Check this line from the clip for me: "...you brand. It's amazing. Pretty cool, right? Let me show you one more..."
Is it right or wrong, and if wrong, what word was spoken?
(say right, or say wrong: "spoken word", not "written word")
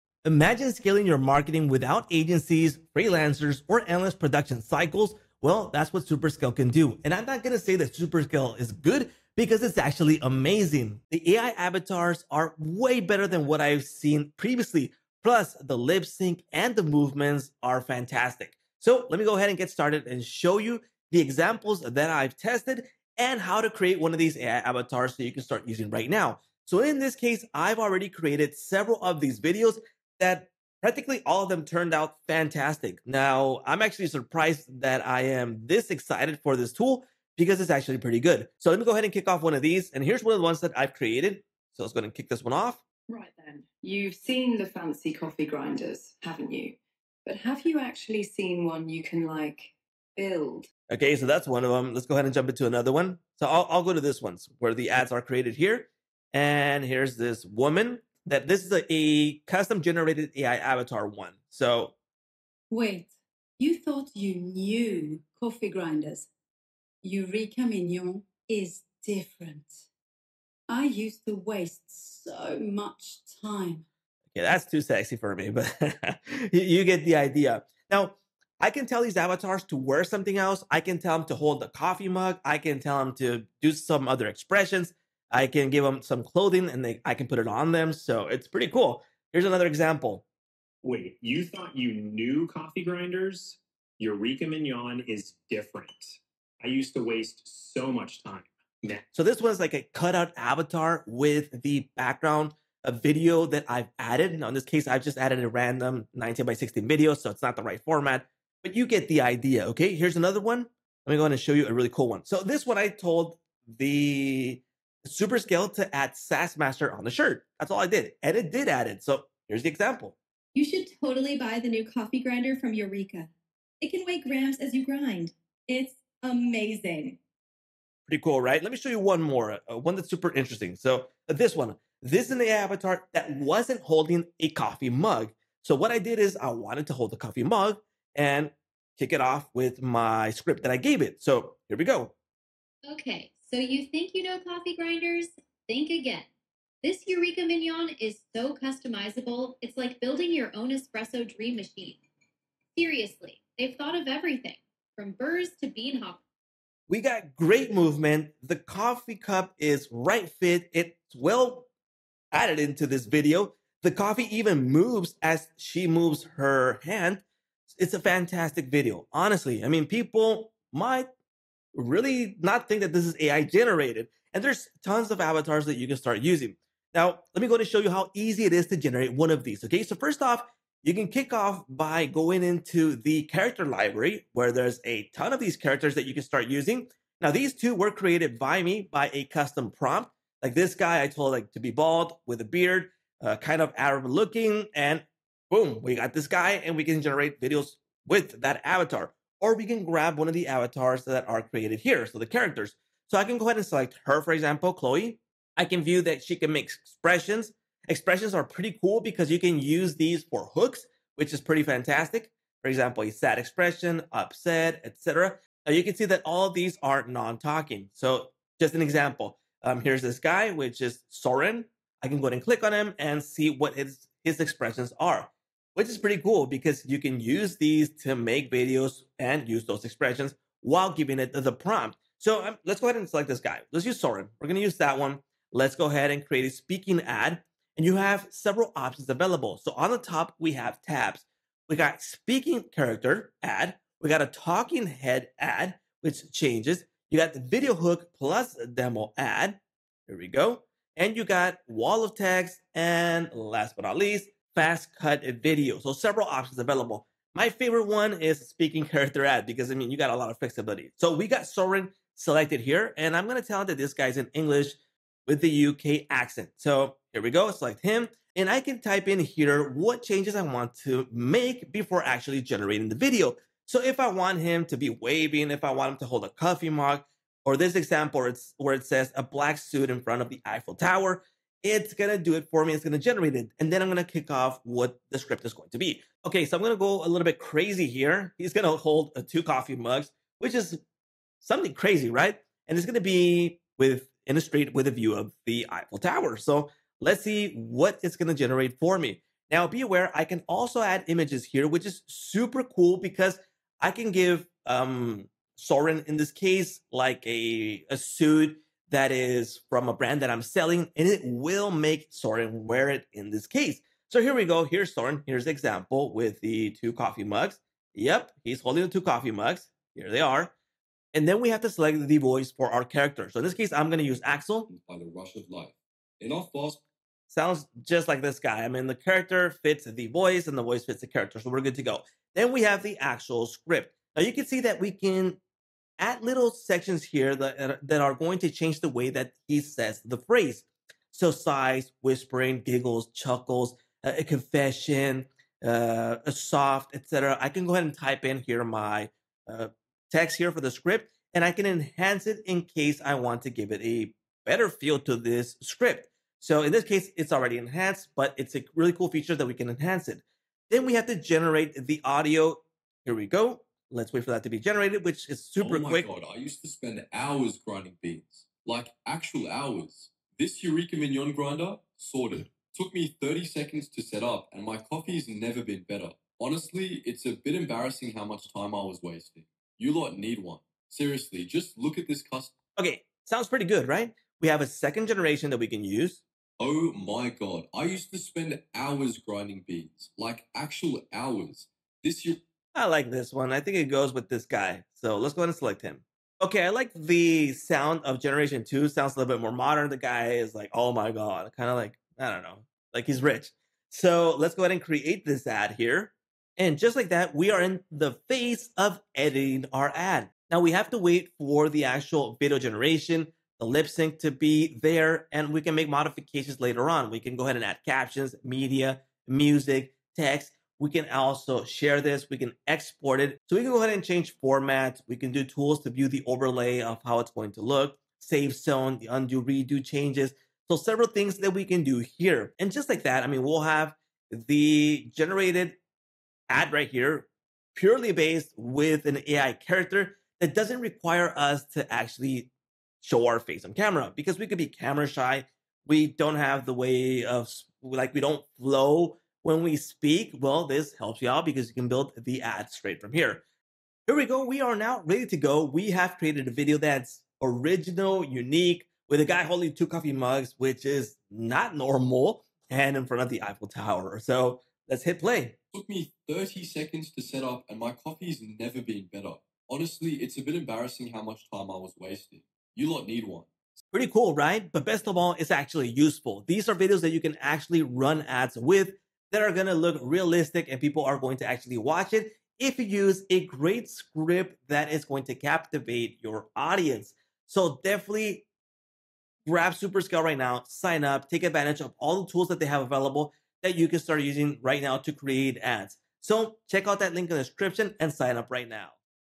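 wrong: "grind", not "brand".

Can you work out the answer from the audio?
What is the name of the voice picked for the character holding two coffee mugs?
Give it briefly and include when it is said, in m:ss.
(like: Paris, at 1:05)
Axel, at 5:24.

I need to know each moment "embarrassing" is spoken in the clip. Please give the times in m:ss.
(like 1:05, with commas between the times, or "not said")
6:17, 7:50.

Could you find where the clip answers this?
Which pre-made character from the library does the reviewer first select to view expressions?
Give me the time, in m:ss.
3:24.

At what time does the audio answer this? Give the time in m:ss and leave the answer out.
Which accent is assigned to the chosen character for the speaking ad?
4:25.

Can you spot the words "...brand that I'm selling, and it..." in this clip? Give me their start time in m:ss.
5:09.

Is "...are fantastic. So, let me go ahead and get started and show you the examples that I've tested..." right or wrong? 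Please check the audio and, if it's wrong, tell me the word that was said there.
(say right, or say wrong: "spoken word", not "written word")
right.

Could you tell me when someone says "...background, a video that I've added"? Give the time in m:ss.
1:41.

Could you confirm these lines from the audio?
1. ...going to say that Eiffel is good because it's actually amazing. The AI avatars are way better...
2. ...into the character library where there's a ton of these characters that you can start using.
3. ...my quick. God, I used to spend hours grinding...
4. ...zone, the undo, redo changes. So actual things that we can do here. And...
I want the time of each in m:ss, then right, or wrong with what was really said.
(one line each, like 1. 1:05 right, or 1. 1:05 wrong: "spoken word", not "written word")
1. 0:07 wrong: "Superscale", not "Eiffel"
2. 3:02 right
3. 6:05 right
4. 7:08 wrong: "several", not "actual".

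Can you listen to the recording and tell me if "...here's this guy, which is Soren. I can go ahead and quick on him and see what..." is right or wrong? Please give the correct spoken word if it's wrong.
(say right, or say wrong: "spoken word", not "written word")
wrong: "click", not "quick".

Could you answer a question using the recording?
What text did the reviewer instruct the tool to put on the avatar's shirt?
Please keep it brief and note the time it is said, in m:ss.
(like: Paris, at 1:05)
SaaS Master, at 1:56.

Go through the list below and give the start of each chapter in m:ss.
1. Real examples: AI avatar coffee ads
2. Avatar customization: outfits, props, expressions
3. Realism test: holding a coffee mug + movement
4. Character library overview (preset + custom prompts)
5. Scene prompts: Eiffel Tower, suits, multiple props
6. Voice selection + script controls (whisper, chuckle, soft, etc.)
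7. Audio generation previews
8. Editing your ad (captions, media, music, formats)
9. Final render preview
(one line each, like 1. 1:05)
1. 0:39
2. 1:20
3. 2:11
4. 2:54
5. 4:20
6. 5:21
7. 6:03
8. 6:46
9. 7:35.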